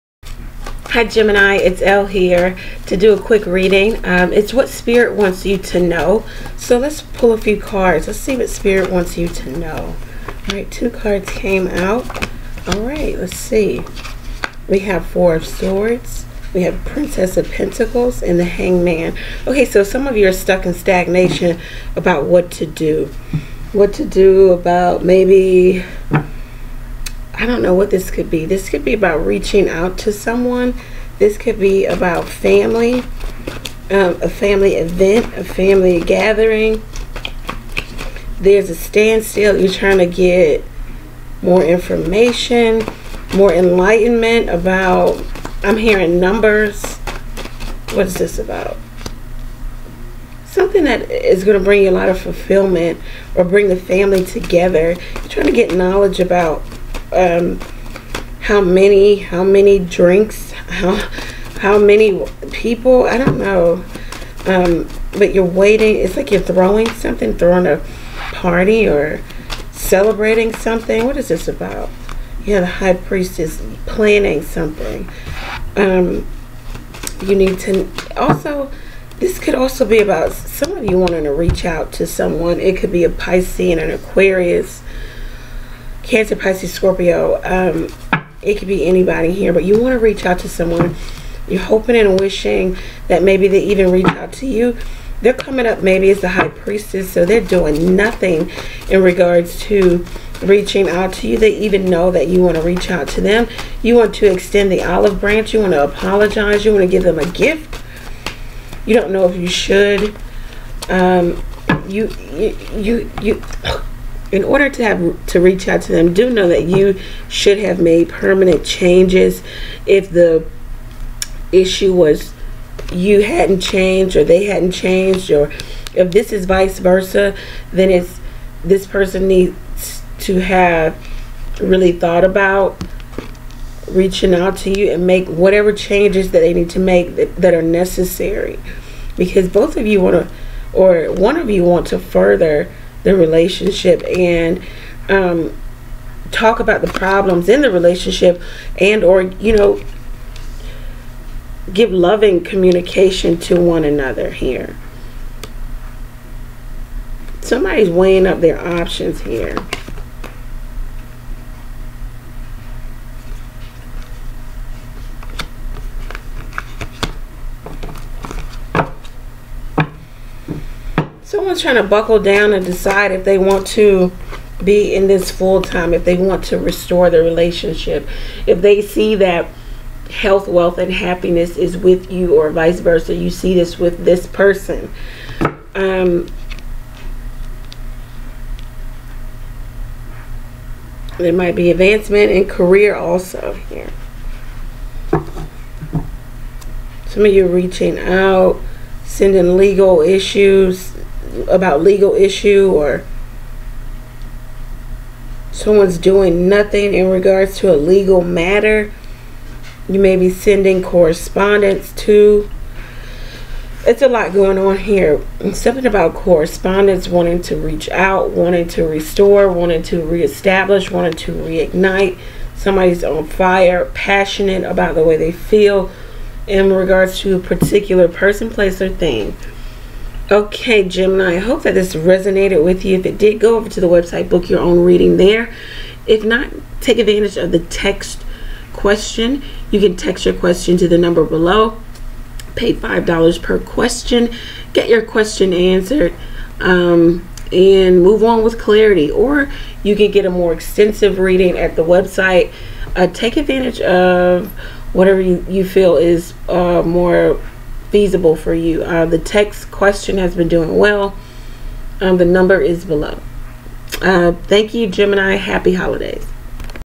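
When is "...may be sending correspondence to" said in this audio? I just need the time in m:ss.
3:29.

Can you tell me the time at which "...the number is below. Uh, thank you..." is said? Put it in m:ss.
4:22.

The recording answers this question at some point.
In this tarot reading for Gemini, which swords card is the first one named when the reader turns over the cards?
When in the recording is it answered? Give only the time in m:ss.
0:15.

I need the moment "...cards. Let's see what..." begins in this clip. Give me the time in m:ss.
0:07.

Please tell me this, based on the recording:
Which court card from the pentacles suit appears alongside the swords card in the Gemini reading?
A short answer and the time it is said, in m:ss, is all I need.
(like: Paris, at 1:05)
Princess of Pentacles, at 0:16.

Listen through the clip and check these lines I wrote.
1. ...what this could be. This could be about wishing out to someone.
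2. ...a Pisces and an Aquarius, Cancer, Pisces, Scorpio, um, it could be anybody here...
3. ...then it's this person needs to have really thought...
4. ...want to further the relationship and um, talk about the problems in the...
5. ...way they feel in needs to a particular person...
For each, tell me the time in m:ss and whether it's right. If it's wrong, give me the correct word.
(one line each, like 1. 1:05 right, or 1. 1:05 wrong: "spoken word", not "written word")
1. 0:27 wrong: "reaching", not "wishing"
2. 1:23 right
3. 2:07 right
4. 2:21 right
5. 3:45 wrong: "regards", not "needs".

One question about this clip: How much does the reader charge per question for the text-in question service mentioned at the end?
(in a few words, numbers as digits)
$5.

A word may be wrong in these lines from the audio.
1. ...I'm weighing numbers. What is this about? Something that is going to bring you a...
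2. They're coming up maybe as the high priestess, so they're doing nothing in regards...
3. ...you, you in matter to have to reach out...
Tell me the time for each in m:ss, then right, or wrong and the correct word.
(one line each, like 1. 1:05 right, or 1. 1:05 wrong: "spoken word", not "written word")
1. 0:45 wrong: "hearing", not "weighing"
2. 1:35 right
3. 1:52 wrong: "order", not "matter".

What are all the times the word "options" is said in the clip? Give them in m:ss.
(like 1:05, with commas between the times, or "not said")
2:38.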